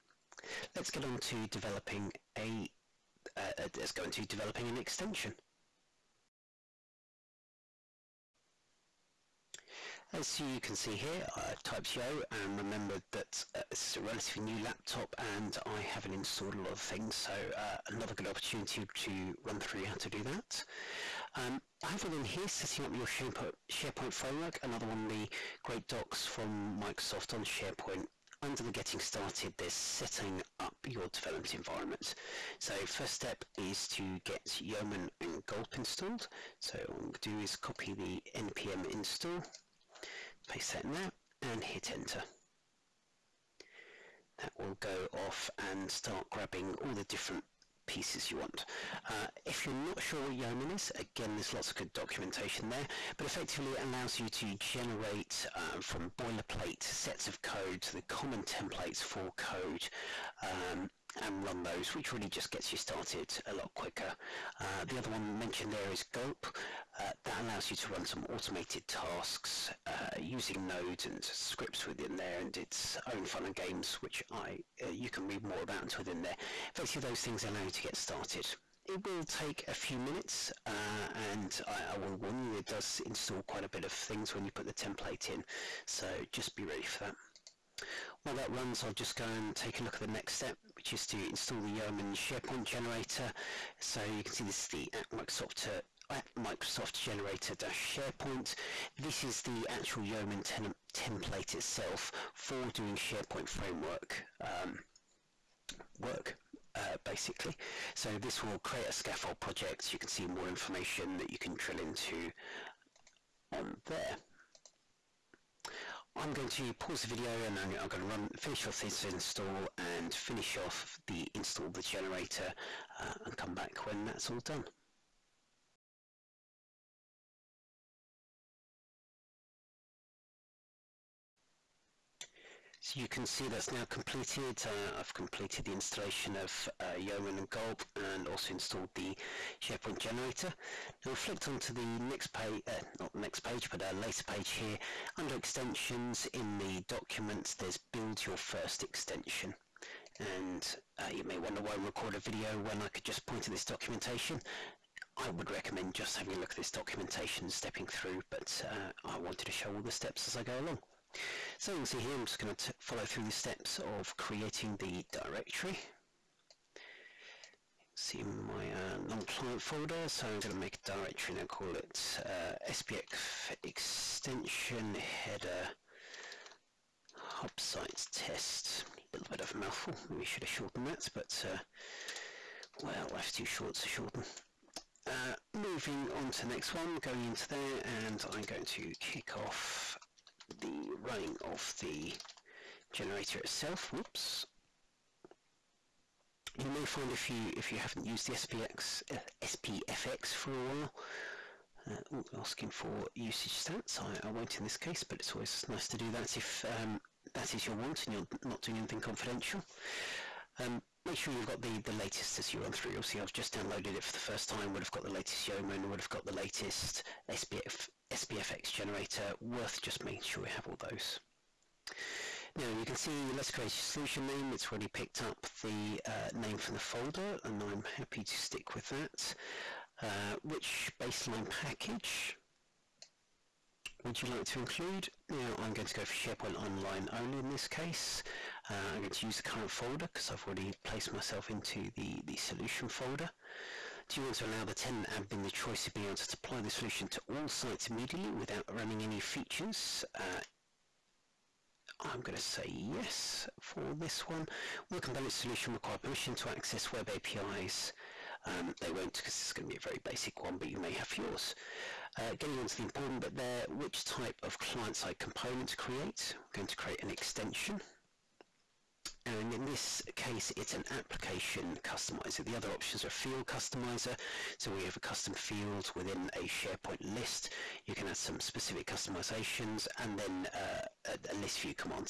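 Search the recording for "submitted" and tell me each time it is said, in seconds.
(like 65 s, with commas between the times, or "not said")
not said.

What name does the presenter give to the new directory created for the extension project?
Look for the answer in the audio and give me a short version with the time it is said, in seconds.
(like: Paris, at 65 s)
extension header hub site test, at 173 s.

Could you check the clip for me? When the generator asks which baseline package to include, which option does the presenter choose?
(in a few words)
SharePoint Online only.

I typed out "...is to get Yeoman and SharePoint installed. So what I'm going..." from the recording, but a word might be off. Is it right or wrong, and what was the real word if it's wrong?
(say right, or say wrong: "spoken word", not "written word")
wrong: "Gulp", not "SharePoint".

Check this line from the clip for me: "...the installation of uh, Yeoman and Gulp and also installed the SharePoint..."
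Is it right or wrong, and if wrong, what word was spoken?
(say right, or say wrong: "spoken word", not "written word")
right.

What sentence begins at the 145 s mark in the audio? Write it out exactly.
Under extensions in the documents, there's build your first extension.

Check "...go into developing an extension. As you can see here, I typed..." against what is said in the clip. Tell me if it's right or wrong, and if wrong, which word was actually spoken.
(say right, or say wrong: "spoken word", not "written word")
right.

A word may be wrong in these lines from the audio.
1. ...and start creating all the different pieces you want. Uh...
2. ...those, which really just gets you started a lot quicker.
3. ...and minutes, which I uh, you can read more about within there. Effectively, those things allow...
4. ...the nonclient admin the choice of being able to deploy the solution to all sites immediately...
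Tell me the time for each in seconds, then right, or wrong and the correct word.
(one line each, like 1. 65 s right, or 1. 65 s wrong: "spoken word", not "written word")
1. 45 s wrong: "grabbing", not "creating"
2. 61 s right
3. 73 s wrong: "games", not "minutes"
4. 244 s wrong: "tenant", not "nonclient".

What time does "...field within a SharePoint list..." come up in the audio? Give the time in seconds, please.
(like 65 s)
275 s.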